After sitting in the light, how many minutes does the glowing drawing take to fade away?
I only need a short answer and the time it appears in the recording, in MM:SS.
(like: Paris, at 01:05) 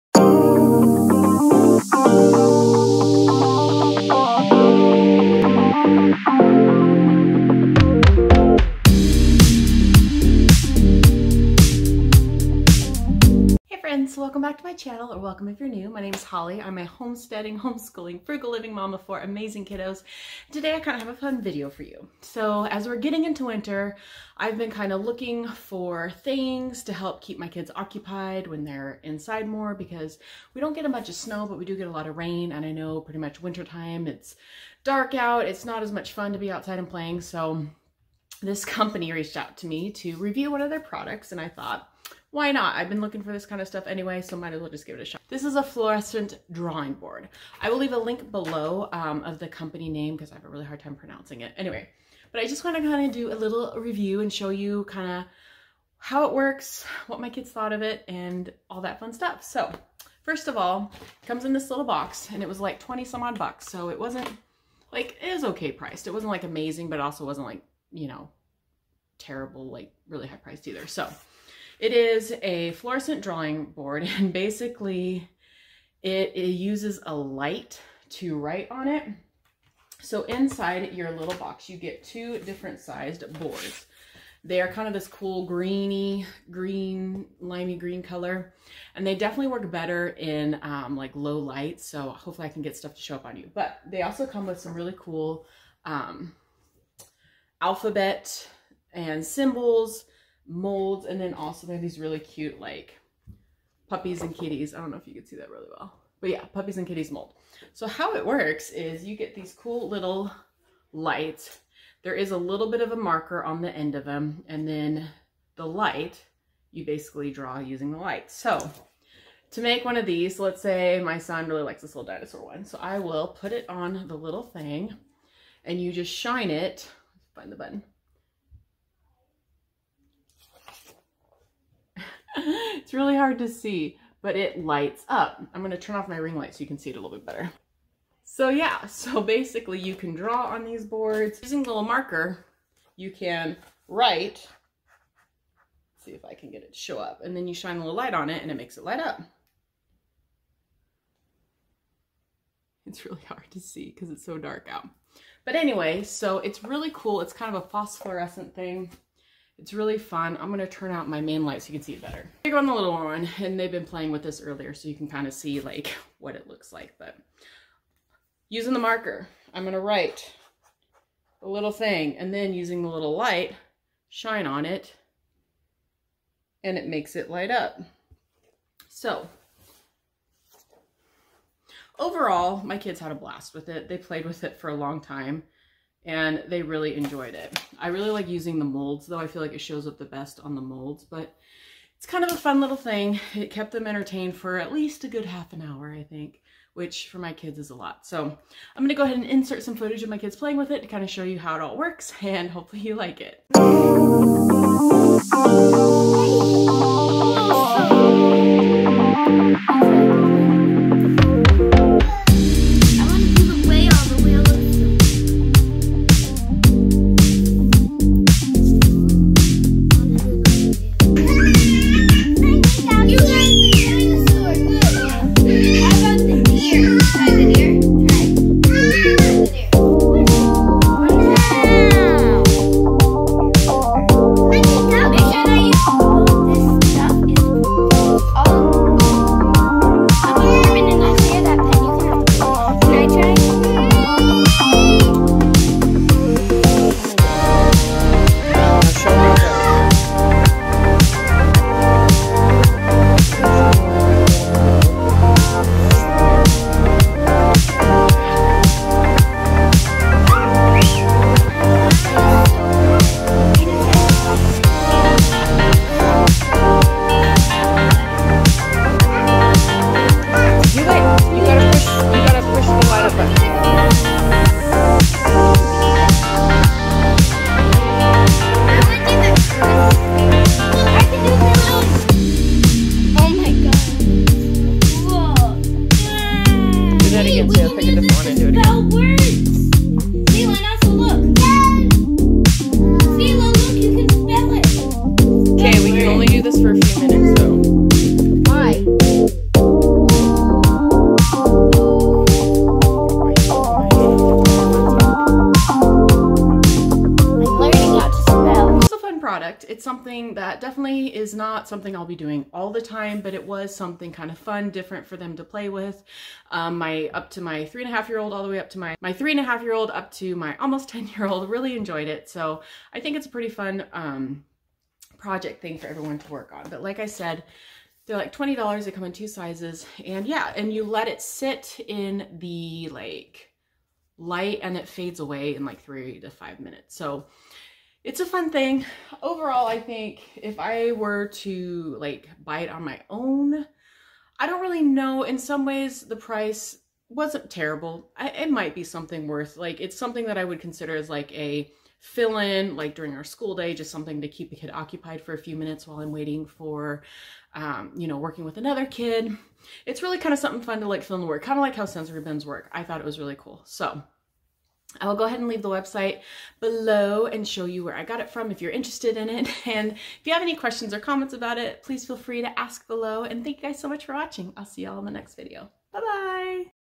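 3 to 5 minutes, at 05:35.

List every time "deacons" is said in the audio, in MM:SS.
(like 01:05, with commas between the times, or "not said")
not said.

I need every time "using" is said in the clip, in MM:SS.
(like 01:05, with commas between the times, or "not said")
01:57, 02:21, 02:48, 02:52, 03:08.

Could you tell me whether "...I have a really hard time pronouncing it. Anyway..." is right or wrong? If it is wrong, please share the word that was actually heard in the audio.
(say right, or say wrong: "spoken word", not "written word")
right.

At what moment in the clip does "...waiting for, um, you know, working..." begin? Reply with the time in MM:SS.
05:56.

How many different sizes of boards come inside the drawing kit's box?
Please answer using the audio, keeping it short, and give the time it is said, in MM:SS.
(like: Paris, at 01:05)
2, at 01:22.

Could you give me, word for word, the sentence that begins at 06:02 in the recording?
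I thought it was really cool.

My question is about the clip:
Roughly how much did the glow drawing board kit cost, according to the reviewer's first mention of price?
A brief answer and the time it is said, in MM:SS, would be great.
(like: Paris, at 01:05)
20 some odd bucks, at 01:02.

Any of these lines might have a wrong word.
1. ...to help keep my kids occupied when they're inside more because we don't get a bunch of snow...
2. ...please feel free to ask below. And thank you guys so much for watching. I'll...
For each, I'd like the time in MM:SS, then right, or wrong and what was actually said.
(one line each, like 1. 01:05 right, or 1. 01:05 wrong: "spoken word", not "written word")
1. 00:26 right
2. 06:11 right.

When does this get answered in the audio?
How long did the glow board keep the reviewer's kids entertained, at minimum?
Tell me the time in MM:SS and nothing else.
03:15.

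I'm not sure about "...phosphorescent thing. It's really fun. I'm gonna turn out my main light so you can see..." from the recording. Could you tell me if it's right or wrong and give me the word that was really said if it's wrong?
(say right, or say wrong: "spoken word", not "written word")
right.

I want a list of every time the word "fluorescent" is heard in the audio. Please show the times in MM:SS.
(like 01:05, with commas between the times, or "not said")
00:45, 01:12.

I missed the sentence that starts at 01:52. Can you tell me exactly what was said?
There is a little bit of a marker on the end of them.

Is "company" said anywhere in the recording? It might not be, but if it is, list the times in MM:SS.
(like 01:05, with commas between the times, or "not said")
00:38, 00:49.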